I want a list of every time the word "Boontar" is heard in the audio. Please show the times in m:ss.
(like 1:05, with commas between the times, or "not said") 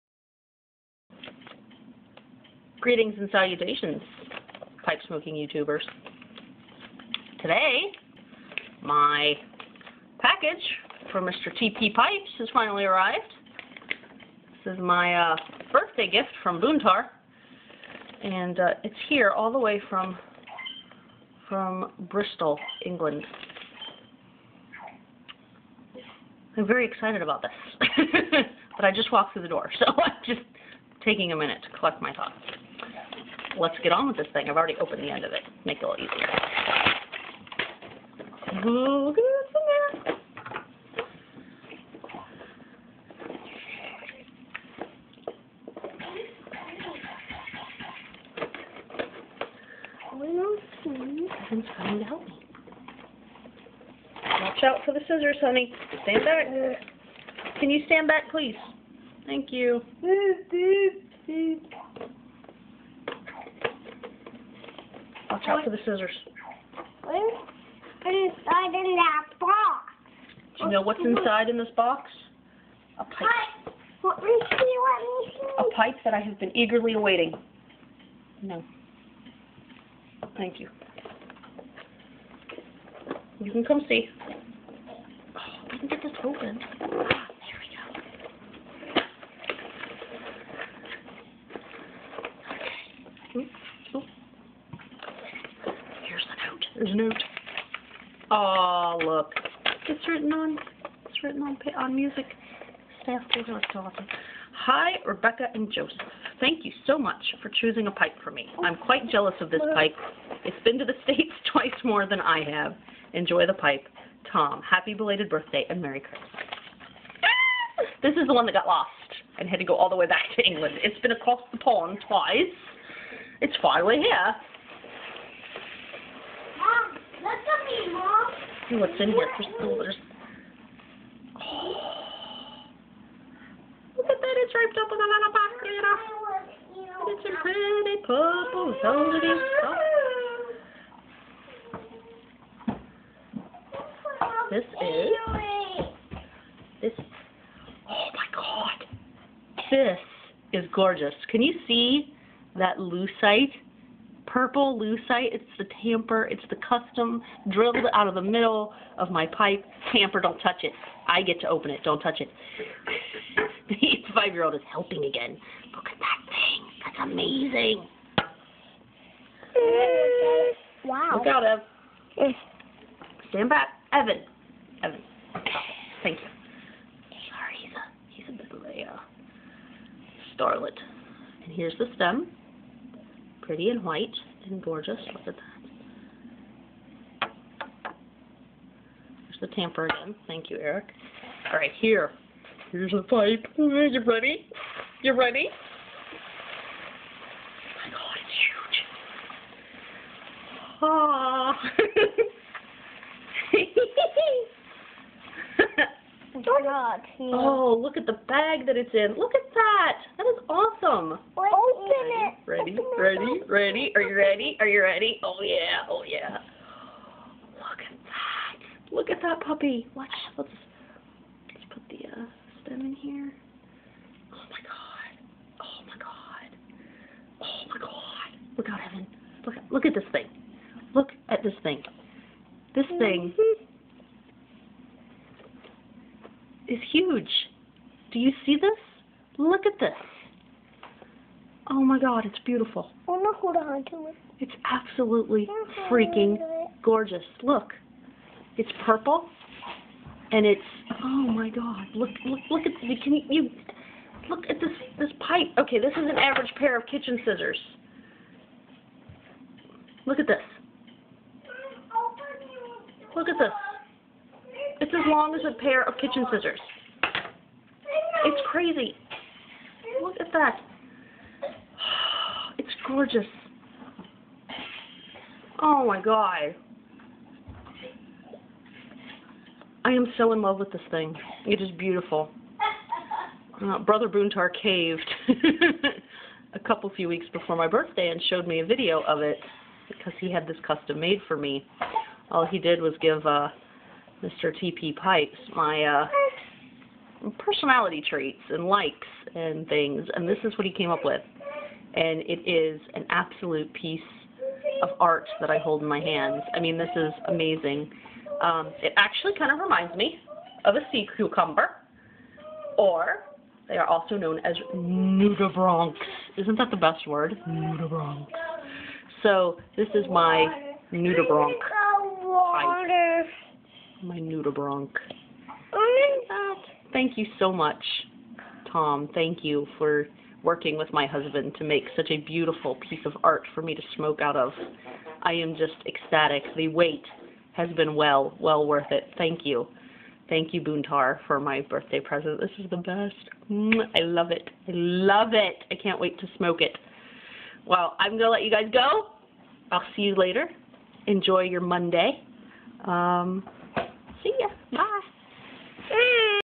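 0:16, 4:44, 5:40.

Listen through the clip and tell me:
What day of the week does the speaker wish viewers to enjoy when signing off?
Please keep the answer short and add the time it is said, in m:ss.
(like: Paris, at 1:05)
Monday, at 5:51.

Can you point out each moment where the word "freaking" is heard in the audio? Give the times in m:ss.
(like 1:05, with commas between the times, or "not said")
4:05.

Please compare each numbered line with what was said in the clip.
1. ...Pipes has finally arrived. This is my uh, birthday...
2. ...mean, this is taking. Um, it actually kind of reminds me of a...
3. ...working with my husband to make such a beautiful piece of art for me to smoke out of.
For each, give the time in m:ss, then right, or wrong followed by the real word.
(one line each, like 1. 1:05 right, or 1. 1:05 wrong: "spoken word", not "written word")
1. 0:11 right
2. 5:06 wrong: "amazing", not "taking"
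3. 5:30 right.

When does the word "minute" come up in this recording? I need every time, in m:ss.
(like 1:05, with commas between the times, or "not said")
0:31.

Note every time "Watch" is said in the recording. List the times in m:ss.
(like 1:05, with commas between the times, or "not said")
0:54, 1:05, 3:39.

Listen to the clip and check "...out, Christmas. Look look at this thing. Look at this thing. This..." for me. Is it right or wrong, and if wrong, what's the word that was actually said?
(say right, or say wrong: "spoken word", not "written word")
wrong: "Evan", not "Christmas".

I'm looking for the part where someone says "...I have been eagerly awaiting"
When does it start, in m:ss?
1:16.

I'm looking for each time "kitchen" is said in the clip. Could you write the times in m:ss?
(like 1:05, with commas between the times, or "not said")
4:16, 4:25.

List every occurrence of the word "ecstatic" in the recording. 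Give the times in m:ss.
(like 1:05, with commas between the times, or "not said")
5:35.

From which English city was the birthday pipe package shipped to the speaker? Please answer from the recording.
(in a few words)
Bristol.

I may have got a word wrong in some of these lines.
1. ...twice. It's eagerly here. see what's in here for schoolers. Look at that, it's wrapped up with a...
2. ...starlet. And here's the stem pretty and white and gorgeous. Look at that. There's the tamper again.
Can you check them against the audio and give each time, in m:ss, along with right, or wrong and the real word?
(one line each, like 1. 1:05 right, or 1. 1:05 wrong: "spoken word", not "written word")
1. 2:02 wrong: "finally", not "eagerly"
2. 3:00 right.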